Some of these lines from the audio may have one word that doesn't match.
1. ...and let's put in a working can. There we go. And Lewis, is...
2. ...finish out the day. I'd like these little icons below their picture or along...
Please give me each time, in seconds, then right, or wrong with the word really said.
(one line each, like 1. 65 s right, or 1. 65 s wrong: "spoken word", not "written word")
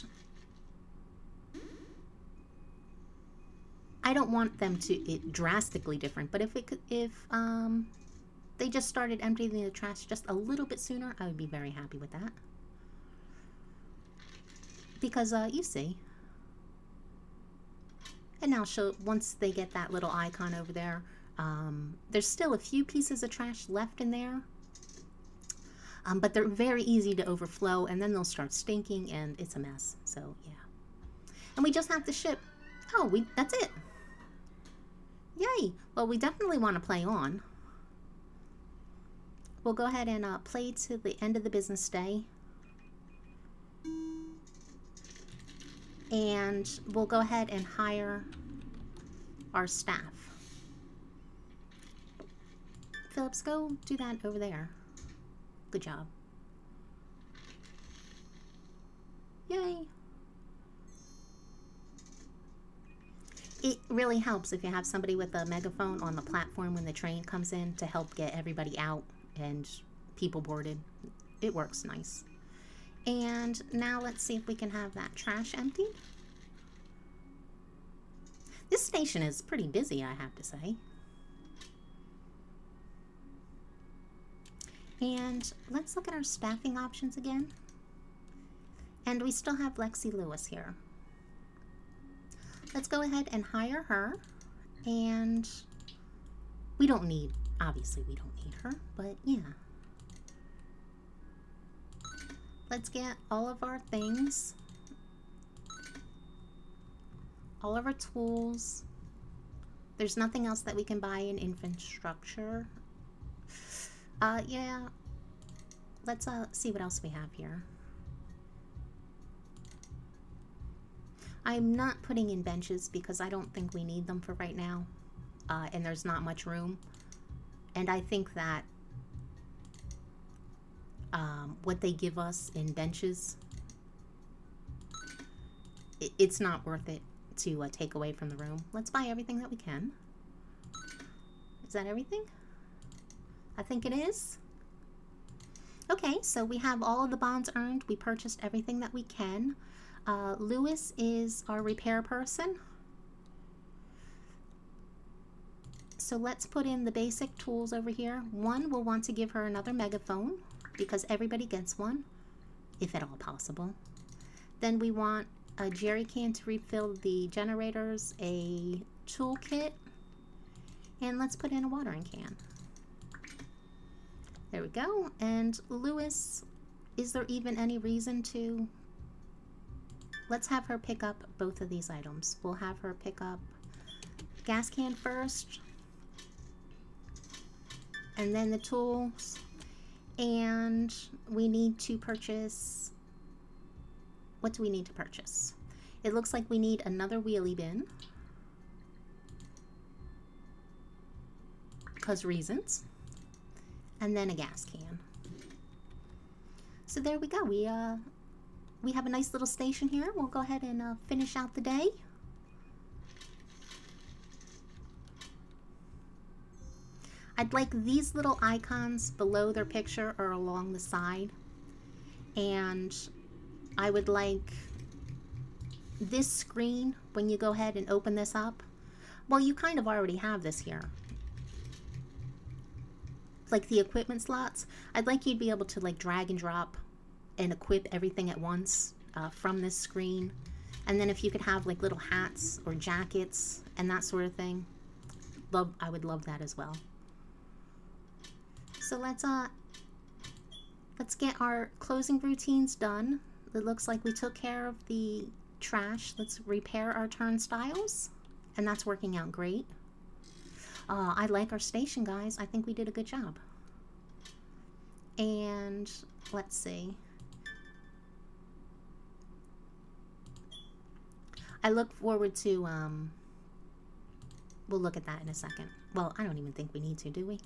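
1. 171 s wrong: "watering", not "working"
2. 211 s right.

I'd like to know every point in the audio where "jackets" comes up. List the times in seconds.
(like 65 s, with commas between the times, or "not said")
242 s.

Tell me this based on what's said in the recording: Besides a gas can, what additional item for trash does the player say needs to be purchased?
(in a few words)
Wheelie bin.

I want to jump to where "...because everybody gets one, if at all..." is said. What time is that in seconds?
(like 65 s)
160 s.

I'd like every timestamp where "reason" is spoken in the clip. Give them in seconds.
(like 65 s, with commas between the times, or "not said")
177 s, 202 s.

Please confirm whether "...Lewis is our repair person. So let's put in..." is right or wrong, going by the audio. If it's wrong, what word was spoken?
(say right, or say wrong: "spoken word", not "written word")
right.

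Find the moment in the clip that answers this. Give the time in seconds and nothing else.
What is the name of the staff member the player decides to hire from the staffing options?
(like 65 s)
89 s.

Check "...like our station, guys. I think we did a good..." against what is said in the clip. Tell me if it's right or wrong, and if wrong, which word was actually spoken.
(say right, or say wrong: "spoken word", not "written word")
right.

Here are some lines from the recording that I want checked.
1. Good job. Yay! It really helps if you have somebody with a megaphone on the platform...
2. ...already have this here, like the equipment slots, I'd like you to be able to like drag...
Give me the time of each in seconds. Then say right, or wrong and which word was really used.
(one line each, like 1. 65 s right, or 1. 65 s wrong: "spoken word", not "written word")
1. 55 s right
2. 229 s right.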